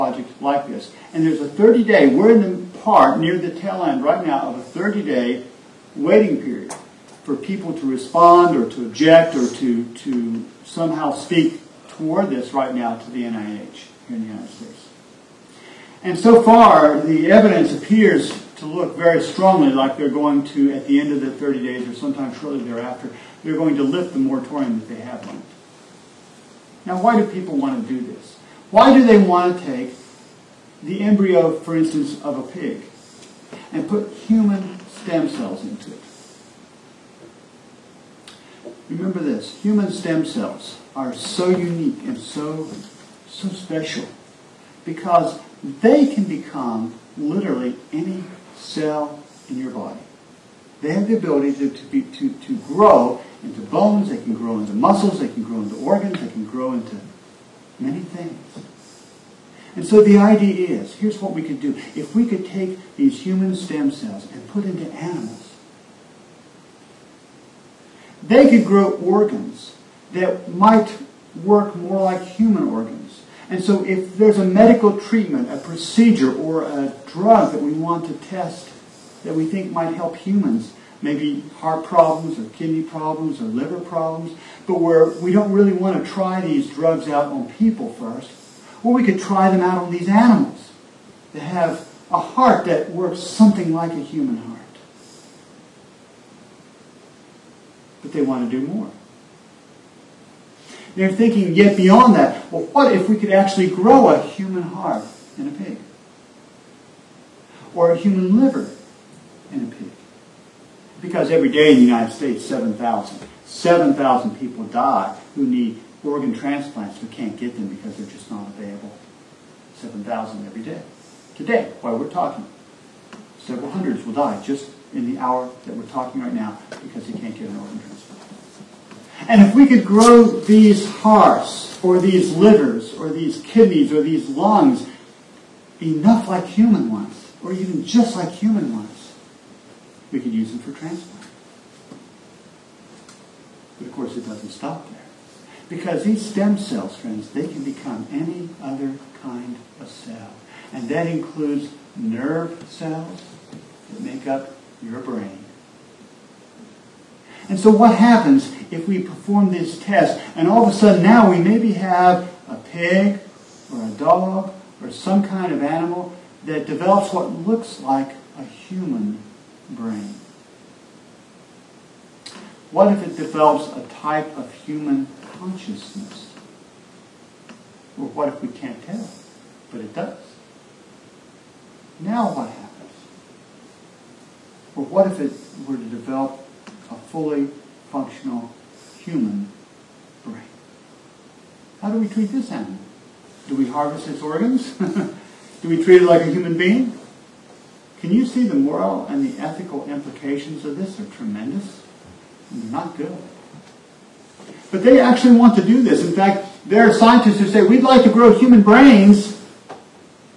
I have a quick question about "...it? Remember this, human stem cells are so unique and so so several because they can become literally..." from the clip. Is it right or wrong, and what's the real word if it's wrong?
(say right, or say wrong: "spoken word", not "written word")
wrong: "special", not "several".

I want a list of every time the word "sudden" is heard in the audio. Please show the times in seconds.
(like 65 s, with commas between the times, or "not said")
160 s.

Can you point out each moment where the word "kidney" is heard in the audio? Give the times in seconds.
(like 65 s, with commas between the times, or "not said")
82 s, 133 s.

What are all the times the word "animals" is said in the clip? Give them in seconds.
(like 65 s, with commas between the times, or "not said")
64 s, 90 s, 165 s, 192 s.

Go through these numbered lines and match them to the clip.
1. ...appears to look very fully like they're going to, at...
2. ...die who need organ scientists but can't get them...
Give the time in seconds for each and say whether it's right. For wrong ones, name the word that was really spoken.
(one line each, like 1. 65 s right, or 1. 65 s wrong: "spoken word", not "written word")
1. 17 s wrong: "strongly", not "fully"
2. 114 s wrong: "transplants", not "scientists".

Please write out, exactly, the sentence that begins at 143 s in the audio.
But of course, it doesn't stop there.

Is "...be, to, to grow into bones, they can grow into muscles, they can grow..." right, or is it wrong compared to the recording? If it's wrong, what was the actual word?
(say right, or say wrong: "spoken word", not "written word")
right.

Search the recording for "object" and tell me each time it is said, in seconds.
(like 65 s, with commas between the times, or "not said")
8 s.